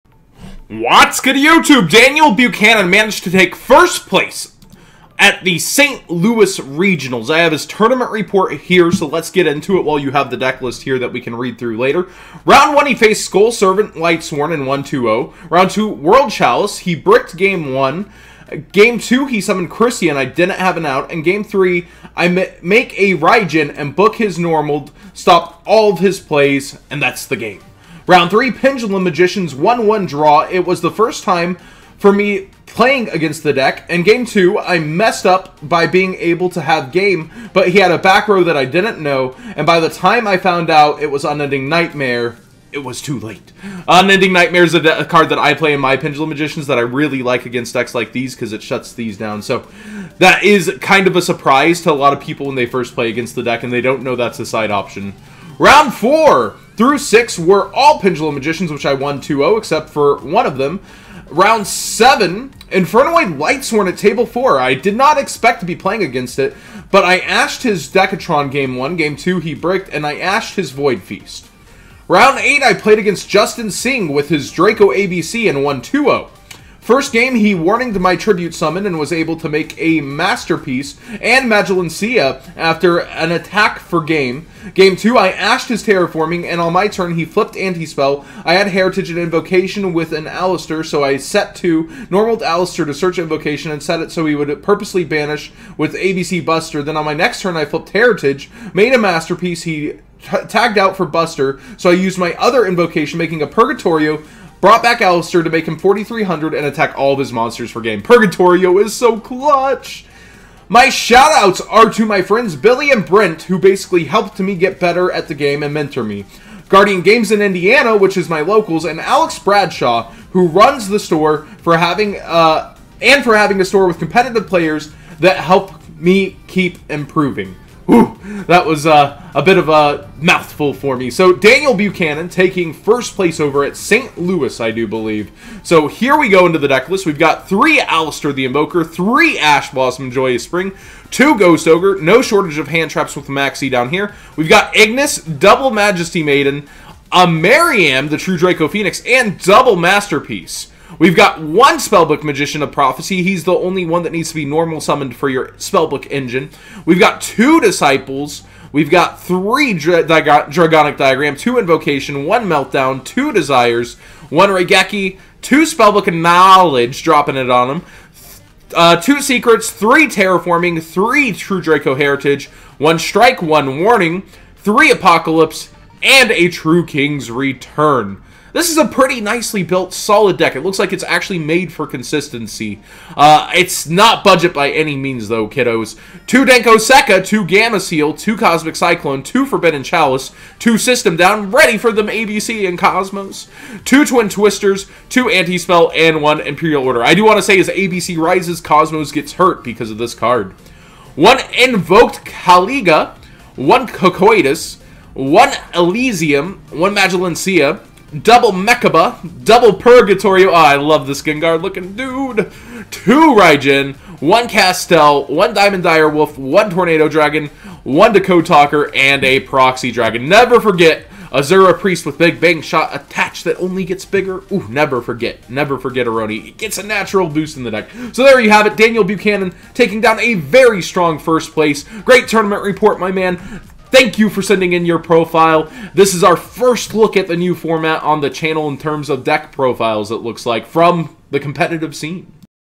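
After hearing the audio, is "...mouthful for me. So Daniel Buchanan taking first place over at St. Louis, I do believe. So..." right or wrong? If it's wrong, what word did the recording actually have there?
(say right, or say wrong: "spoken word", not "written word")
right.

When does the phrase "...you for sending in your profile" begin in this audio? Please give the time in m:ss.
3:54.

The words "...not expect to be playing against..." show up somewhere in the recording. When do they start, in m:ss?
1:04.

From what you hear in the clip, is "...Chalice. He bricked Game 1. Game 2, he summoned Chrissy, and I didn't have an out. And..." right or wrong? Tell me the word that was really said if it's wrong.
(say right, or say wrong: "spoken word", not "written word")
right.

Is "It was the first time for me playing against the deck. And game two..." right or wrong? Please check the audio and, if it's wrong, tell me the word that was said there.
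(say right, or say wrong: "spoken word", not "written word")
right.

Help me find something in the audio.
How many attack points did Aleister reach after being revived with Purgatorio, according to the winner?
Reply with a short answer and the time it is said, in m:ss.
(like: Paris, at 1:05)
4,300, at 1:45.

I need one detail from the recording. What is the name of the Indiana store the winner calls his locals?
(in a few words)
Guardian Games.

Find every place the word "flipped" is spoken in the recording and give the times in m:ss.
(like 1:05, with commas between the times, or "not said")
1:27, 1:37.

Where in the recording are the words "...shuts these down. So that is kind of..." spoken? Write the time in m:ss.
0:48.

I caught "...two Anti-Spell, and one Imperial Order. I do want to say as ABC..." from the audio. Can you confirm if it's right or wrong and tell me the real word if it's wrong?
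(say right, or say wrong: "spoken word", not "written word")
right.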